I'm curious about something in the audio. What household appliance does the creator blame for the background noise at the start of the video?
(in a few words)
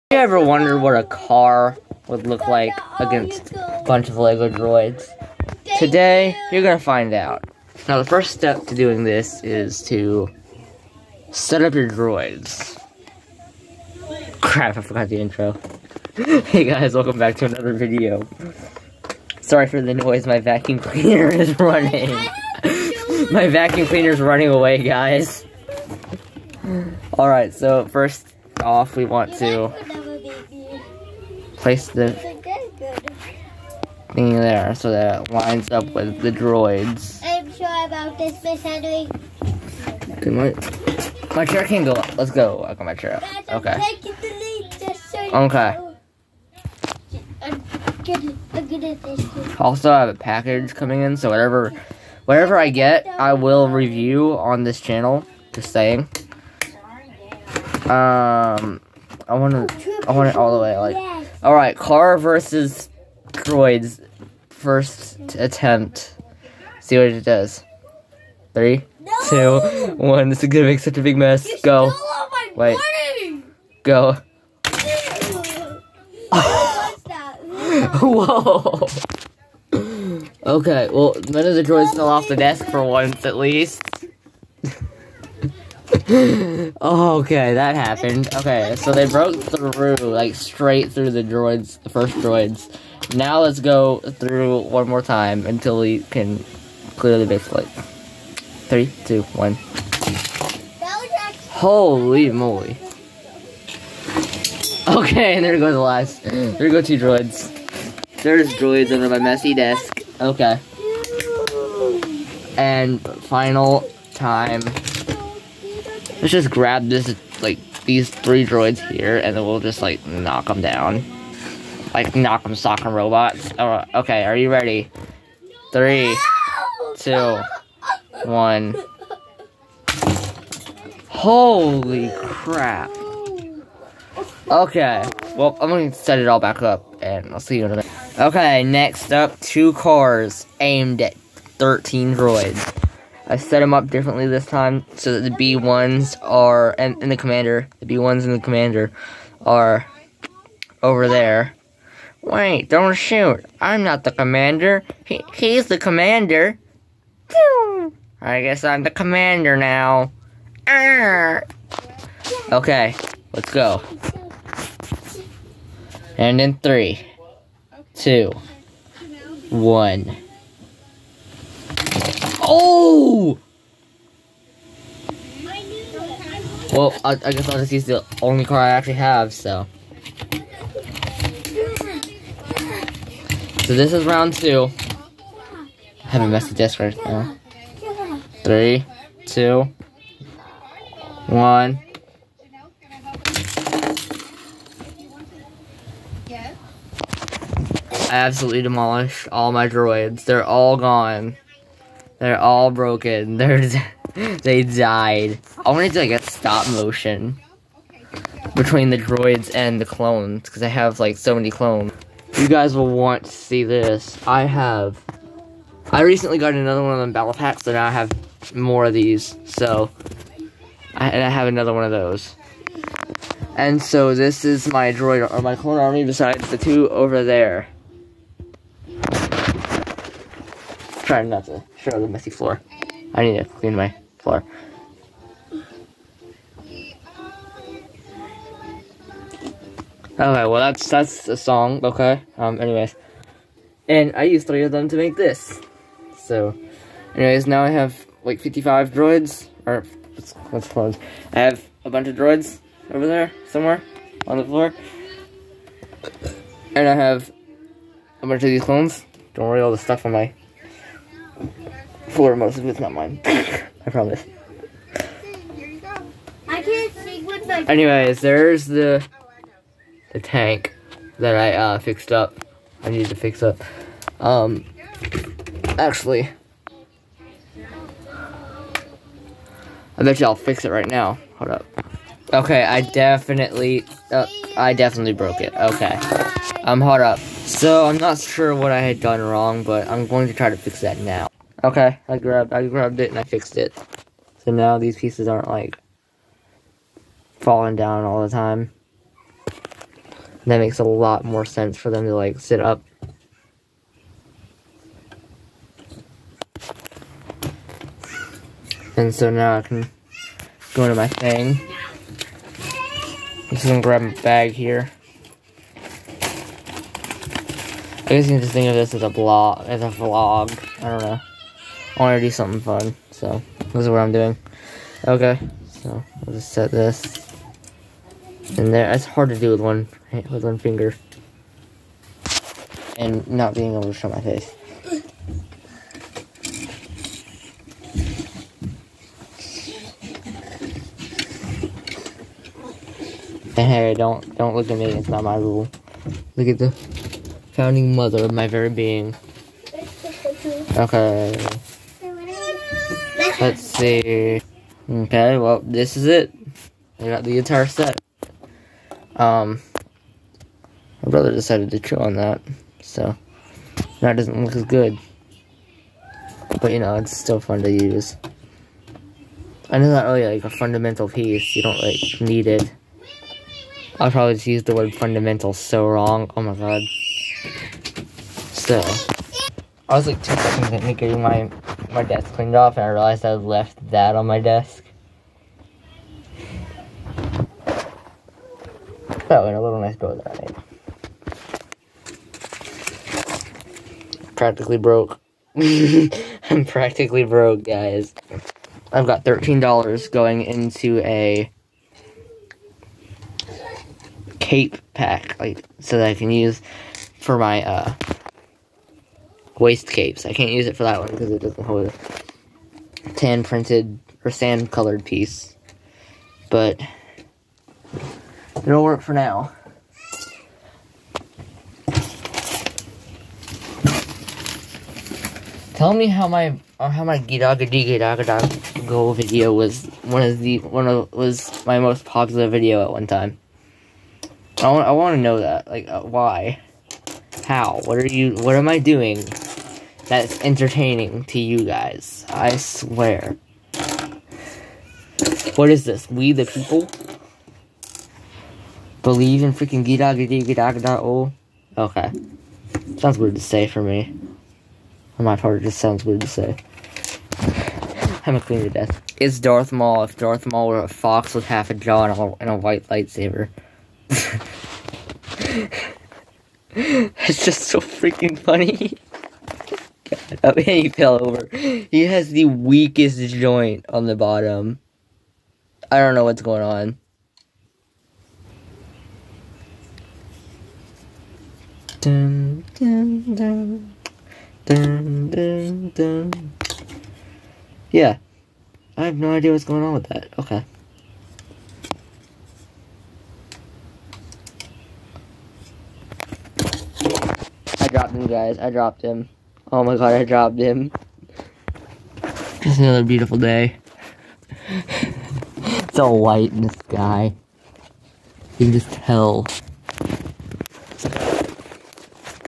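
Vacuum cleaner.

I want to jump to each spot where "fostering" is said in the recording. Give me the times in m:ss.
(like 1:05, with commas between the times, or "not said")
not said.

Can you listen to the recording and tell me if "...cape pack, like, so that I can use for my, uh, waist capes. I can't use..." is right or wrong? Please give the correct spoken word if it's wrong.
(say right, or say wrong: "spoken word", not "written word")
right.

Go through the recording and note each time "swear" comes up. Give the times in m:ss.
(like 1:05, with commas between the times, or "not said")
7:22.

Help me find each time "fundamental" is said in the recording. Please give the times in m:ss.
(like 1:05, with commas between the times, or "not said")
6:10, 6:14.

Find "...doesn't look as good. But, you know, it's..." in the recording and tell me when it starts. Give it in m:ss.
6:04.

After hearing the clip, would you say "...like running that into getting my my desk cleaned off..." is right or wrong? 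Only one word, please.
wrong.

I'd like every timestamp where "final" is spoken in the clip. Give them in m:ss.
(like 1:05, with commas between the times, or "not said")
1:53.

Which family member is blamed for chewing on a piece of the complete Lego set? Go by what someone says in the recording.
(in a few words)
Brother.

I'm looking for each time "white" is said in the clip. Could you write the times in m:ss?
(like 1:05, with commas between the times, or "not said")
7:42, 8:26.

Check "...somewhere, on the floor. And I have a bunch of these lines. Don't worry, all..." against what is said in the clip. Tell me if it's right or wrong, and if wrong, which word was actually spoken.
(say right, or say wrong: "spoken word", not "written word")
wrong: "clones", not "lines".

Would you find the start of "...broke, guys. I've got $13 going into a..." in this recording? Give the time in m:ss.
6:37.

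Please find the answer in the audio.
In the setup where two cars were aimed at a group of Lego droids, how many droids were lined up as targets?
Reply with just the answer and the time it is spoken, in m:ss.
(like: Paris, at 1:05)
13, at 2:21.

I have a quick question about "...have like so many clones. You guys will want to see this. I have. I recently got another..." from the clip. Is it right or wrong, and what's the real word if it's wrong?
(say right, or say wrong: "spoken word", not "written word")
right.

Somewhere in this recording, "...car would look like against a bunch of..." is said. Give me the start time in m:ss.
0:01.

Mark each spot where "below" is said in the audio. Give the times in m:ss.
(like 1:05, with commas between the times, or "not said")
not said.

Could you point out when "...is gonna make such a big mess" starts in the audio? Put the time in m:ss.
1:10.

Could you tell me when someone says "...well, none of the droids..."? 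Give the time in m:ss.
1:20.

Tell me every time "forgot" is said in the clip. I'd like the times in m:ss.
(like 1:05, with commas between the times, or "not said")
0:14.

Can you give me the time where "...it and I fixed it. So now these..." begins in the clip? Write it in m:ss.
4:52.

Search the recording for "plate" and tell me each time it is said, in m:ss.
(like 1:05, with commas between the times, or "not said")
1:37.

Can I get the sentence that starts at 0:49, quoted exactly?
Also, I have a package coming in, so whatever, whatever I get, I will review on this channel.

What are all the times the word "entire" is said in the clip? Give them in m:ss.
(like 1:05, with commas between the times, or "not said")
5:57.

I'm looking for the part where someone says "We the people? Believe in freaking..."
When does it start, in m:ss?
7:26.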